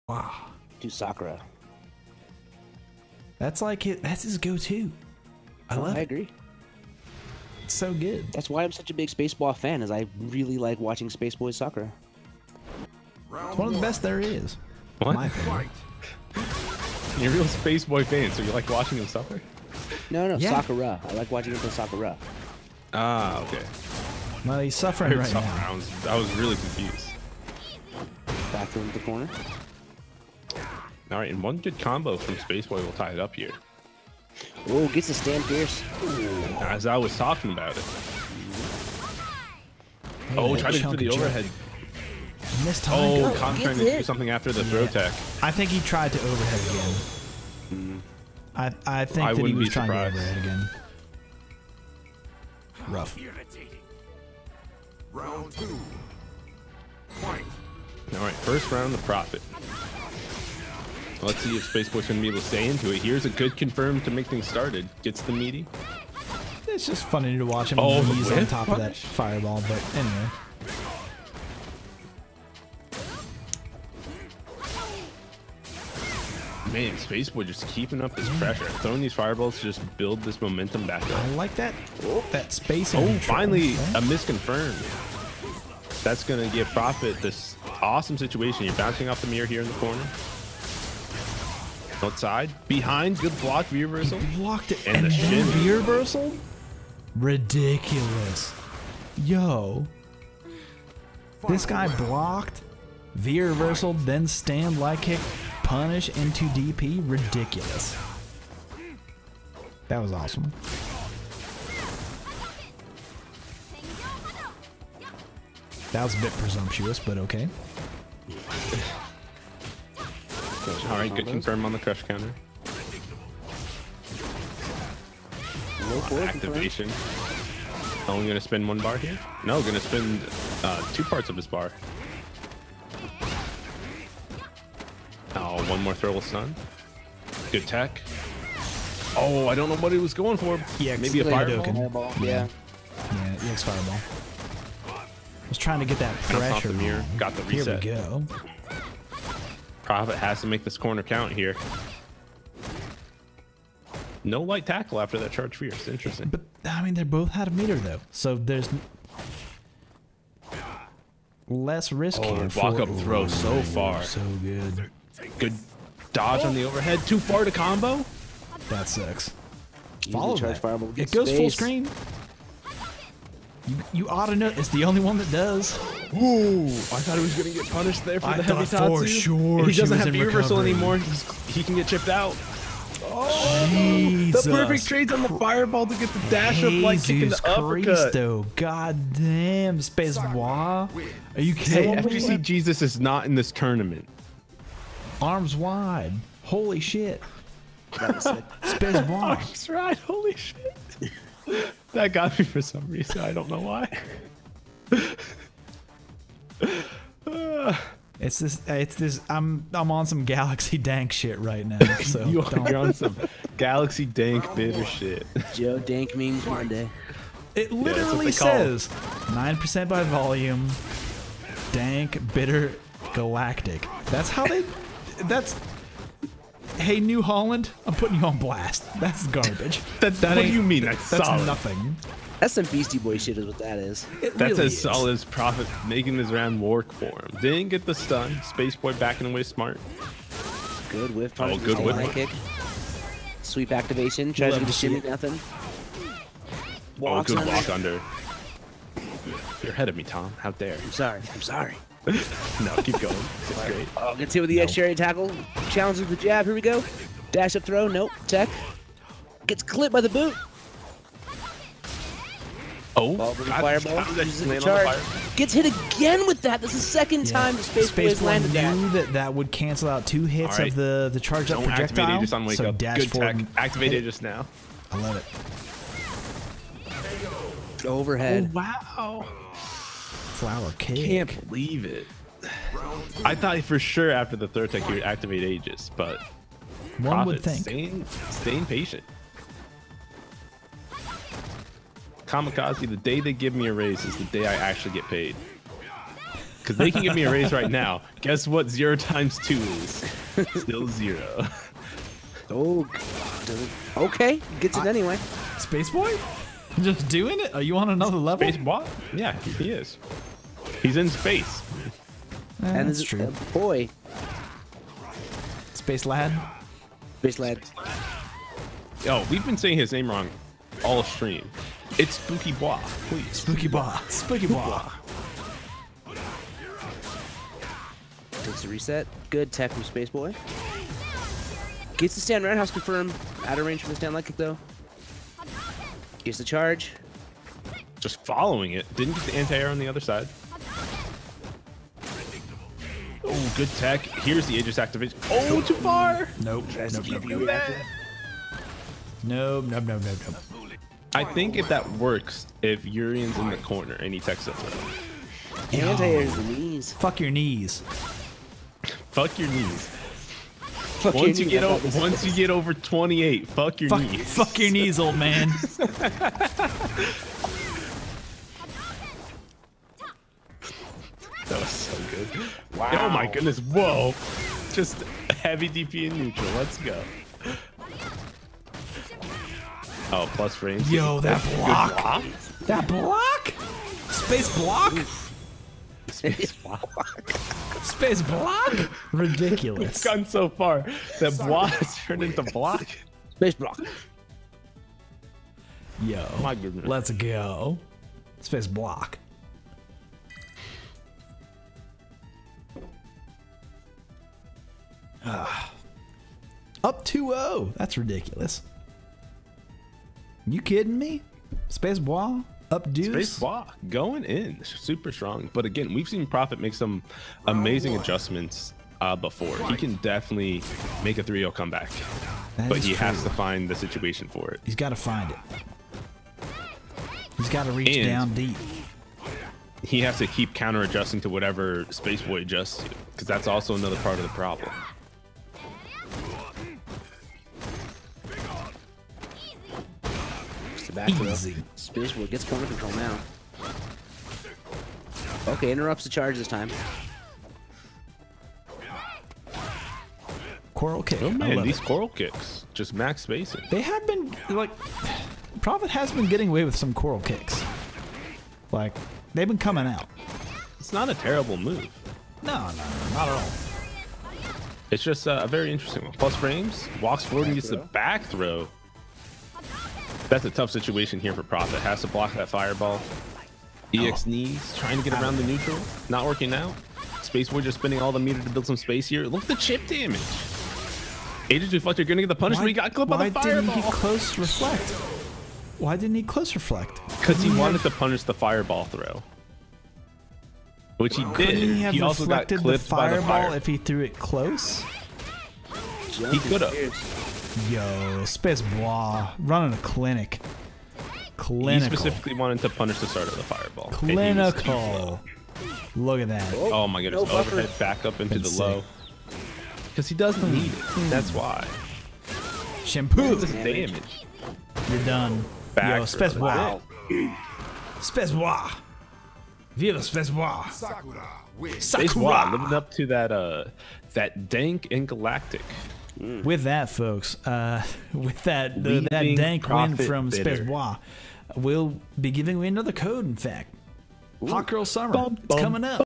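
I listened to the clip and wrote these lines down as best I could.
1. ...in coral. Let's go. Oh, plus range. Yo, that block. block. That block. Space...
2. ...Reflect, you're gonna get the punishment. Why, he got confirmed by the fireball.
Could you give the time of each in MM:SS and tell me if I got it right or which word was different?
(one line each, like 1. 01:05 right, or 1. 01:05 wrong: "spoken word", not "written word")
1. 06:16 wrong: "neutral", not "coral"
2. 08:01 wrong: "clipped", not "confirmed".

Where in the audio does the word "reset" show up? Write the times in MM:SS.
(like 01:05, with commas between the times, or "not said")
02:27, 05:28.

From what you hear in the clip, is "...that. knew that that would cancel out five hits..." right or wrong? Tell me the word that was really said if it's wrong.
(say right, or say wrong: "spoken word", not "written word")
wrong: "two", not "five".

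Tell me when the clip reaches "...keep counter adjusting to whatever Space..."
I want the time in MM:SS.
07:10.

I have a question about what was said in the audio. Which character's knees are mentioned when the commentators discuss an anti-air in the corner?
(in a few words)
Urien.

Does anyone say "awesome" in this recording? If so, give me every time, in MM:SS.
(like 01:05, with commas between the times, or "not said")
01:27, 01:50.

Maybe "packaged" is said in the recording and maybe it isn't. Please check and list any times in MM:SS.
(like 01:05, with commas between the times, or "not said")
not said.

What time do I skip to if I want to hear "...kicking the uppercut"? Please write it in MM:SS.
03:07.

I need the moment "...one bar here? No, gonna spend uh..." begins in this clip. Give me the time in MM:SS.
02:08.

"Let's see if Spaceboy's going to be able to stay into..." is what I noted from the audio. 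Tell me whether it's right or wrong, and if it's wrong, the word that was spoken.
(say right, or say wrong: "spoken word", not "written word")
right.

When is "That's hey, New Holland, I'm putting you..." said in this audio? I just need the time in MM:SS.
03:45.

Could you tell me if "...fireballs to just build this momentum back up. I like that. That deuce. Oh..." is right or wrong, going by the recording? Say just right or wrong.
wrong.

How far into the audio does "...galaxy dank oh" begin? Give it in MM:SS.
03:33.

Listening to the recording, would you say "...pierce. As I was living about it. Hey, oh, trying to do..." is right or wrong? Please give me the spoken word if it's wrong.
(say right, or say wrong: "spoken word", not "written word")
wrong: "talking", not "living".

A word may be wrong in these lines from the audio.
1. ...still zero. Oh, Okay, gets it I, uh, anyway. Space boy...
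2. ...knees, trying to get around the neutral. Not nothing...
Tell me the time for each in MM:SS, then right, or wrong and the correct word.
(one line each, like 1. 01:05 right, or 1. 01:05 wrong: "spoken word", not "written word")
1. 05:00 right
2. 07:54 wrong: "working", not "nothing".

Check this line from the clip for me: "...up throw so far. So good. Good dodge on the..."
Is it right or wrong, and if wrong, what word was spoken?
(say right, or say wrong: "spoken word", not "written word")
right.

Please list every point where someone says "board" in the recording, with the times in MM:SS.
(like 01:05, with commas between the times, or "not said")
not said.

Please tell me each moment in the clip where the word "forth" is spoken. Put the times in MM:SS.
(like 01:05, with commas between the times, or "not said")
not said.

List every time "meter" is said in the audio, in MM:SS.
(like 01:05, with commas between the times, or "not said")
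02:37, 07:58.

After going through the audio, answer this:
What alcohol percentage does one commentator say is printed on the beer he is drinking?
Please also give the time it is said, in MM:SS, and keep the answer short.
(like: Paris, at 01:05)
9 percent, at 03:39.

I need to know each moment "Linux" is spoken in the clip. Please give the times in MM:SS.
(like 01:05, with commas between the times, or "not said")
not said.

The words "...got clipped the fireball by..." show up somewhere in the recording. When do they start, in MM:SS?
08:12.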